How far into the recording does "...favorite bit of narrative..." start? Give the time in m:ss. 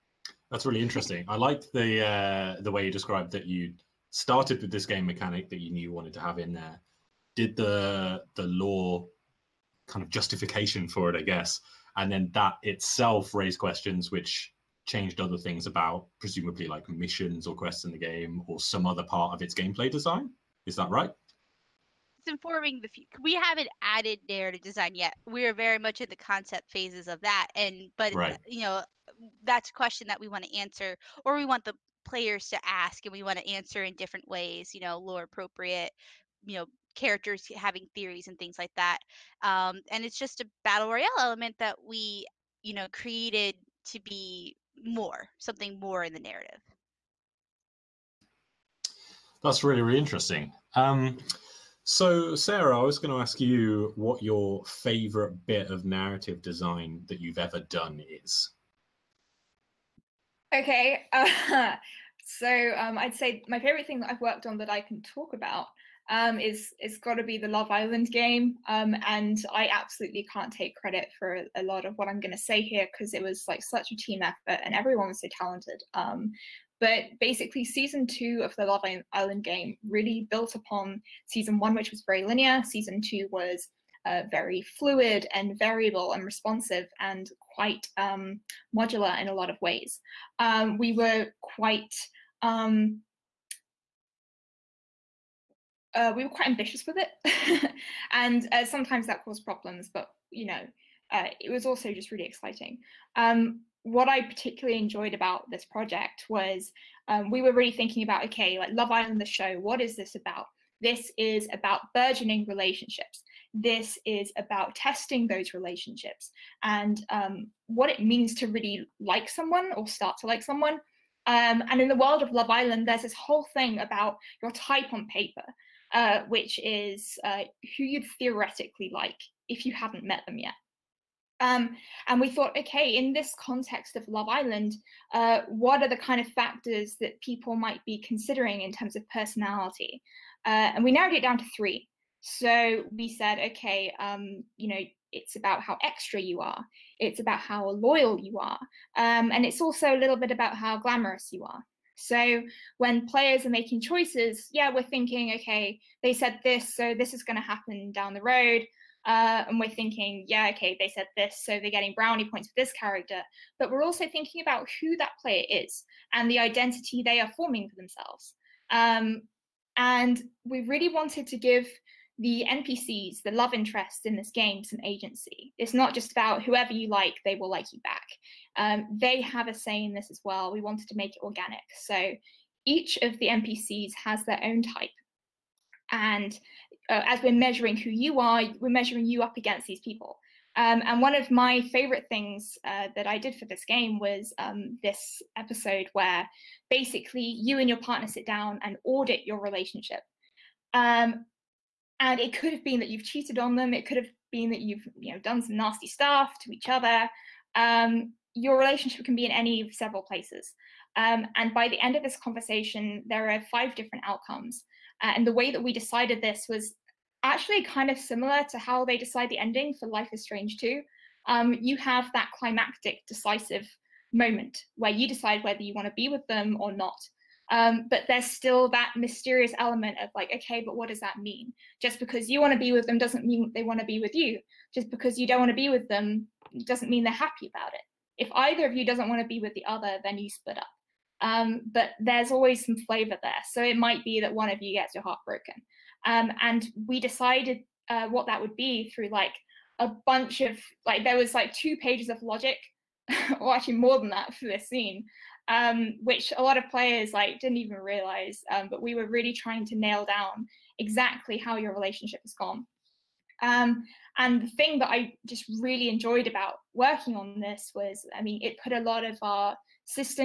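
0:54.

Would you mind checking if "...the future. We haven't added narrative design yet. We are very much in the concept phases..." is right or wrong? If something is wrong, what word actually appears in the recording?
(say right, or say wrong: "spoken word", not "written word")
right.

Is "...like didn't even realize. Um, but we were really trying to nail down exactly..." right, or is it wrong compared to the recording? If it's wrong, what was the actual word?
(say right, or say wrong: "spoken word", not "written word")
right.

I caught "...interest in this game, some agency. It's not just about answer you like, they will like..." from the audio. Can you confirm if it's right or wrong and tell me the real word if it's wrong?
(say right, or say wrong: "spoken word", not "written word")
wrong: "whoever", not "answer".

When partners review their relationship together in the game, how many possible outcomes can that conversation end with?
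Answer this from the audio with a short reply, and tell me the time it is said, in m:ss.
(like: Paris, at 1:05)
5, at 3:33.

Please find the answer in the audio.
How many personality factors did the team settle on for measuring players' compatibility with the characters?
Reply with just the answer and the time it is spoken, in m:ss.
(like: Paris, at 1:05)
3, at 2:21.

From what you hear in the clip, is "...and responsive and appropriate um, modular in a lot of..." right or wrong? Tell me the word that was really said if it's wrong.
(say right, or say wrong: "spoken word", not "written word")
wrong: "quite", not "appropriate".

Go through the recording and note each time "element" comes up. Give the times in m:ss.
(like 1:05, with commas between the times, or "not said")
0:41, 3:49.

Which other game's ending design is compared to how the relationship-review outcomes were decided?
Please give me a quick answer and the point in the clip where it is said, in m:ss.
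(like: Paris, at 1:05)
Life is Strange 2, at 3:39.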